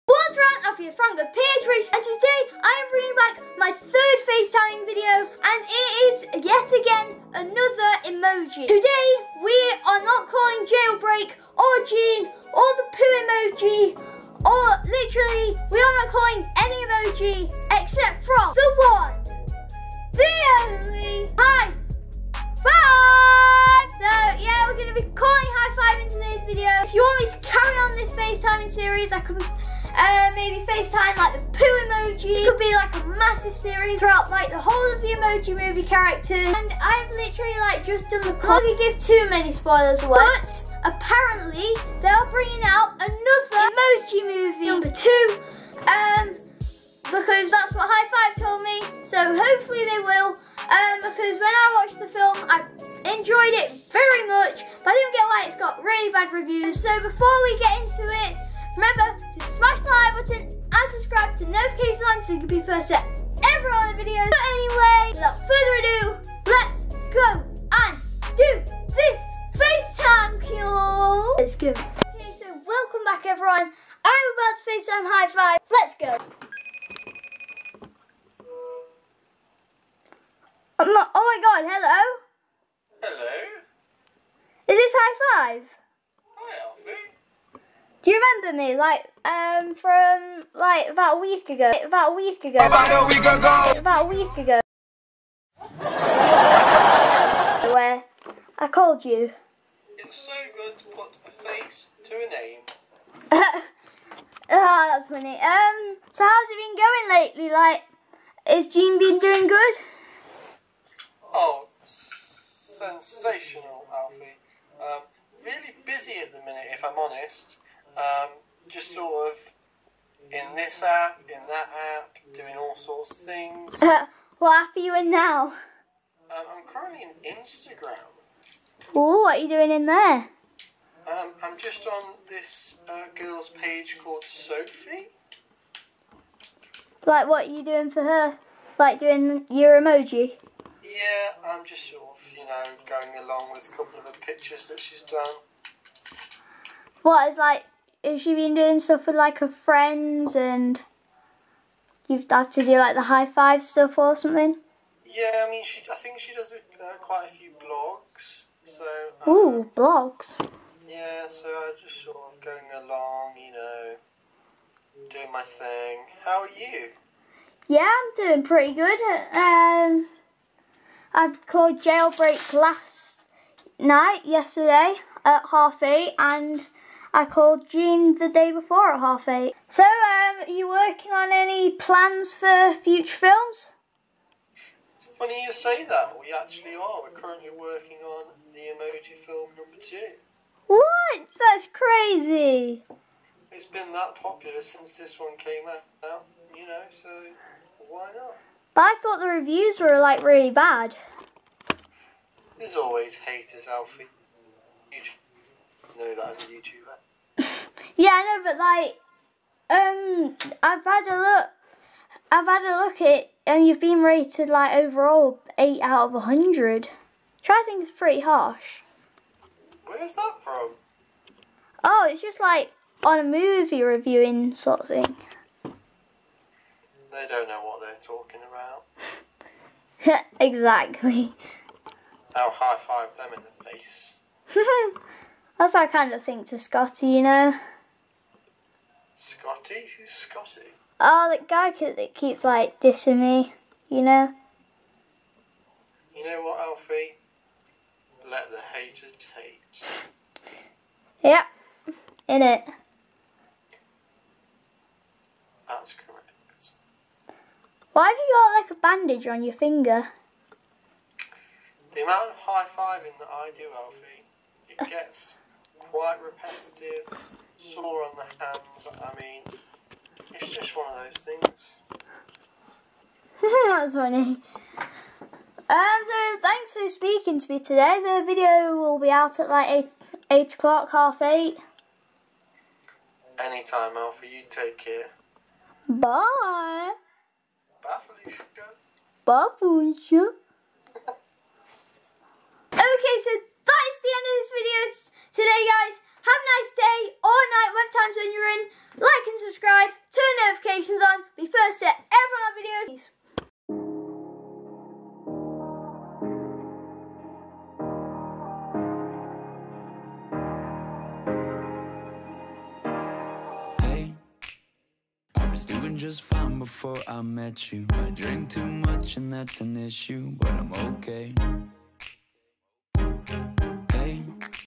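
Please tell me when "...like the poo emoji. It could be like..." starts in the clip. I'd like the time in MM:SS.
00:31.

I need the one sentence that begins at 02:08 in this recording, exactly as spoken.
Oh, what are you doing in there?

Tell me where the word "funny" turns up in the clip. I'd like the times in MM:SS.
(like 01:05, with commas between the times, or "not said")
01:45, 03:05, 04:33.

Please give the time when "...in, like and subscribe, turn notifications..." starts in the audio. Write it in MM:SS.
04:58.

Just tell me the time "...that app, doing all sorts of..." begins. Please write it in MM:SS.
02:01.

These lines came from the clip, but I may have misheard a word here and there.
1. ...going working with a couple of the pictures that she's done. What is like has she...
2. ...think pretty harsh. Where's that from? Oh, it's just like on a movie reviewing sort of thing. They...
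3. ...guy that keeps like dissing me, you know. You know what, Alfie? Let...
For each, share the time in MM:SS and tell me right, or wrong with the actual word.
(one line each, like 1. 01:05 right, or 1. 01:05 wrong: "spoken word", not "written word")
1. 02:22 wrong: "along", not "working"
2. 03:37 right
3. 04:01 right.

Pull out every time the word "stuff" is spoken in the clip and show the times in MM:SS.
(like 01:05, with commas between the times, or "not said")
02:28, 02:33.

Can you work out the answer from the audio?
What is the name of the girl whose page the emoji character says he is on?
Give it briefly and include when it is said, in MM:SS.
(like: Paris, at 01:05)
Sophie, at 02:14.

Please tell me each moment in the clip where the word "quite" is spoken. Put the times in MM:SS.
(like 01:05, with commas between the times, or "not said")
02:36, 04:25.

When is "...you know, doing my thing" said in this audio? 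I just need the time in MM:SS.
02:43.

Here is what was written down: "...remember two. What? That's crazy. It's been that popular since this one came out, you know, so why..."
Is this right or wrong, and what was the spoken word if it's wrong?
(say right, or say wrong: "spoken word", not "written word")
wrong: "number", not "remember".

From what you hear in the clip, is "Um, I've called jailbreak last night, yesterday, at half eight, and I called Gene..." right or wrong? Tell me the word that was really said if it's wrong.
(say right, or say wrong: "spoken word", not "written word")
right.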